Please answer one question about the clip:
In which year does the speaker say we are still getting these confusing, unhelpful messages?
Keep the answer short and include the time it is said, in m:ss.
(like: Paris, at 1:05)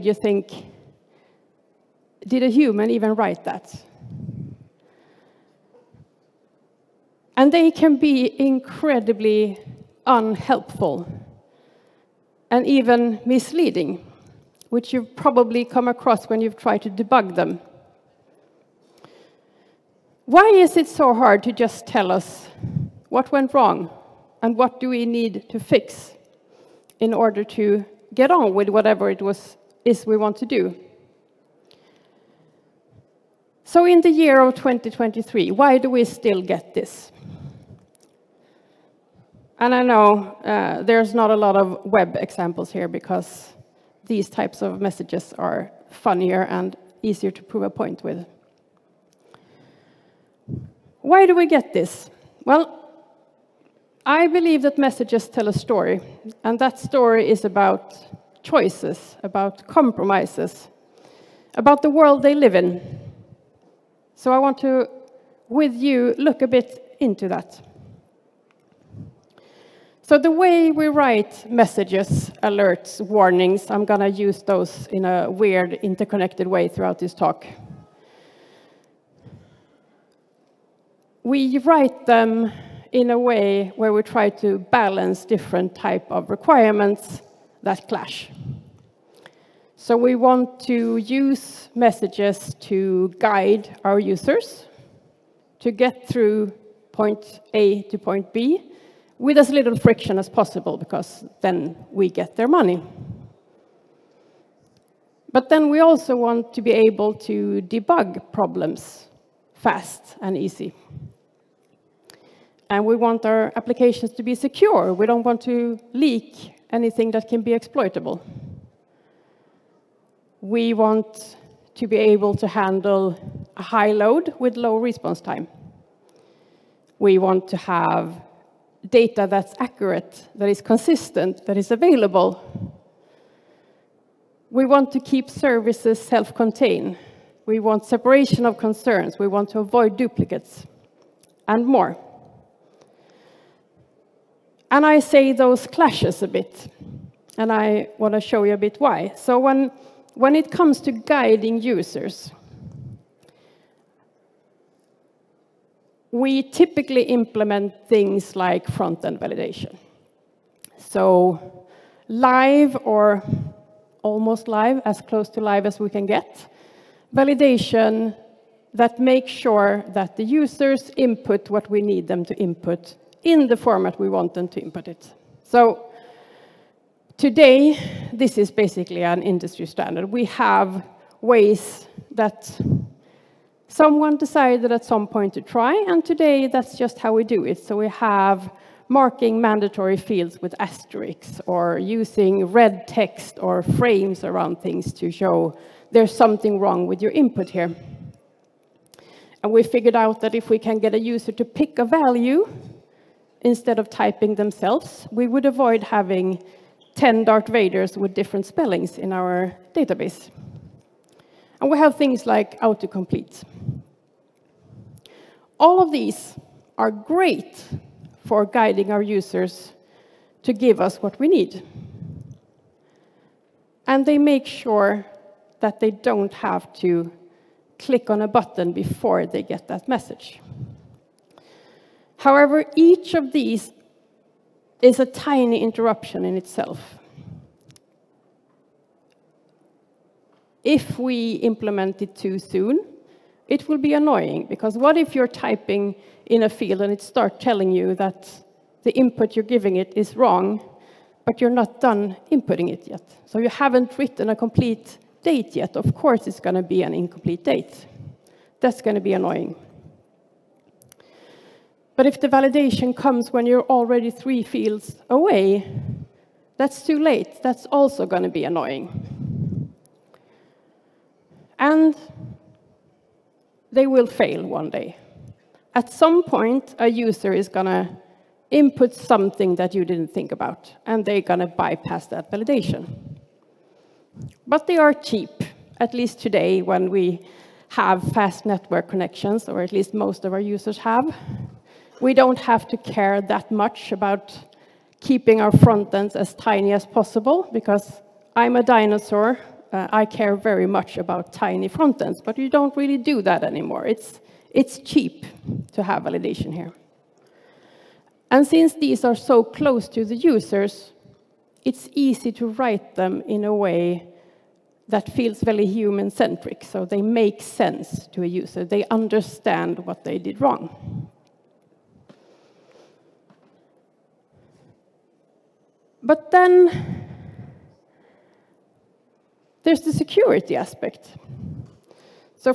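2023, at 0:34.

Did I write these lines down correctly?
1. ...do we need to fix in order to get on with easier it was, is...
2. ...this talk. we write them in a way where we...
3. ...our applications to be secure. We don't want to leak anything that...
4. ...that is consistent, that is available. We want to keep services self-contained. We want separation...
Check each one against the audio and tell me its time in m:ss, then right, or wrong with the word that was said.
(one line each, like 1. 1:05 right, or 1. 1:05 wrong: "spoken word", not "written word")
1. 0:24 wrong: "whatever", not "easier"
2. 1:16 right
3. 1:53 right
4. 2:10 right.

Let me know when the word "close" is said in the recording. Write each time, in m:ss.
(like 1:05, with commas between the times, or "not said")
2:45, 5:09.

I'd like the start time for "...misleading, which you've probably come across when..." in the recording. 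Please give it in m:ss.
0:13.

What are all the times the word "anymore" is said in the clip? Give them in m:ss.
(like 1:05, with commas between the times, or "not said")
5:03.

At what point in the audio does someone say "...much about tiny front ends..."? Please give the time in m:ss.
5:00.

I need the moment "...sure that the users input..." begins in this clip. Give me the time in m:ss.
2:49.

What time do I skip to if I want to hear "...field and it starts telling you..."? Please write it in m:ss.
4:06.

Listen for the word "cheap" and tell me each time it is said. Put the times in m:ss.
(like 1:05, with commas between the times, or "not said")
4:44, 5:04.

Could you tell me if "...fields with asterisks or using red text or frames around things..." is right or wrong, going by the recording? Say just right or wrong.
right.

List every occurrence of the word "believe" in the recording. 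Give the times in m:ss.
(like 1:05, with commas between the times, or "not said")
0:54.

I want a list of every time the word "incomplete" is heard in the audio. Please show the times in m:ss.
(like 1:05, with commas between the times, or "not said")
4:16.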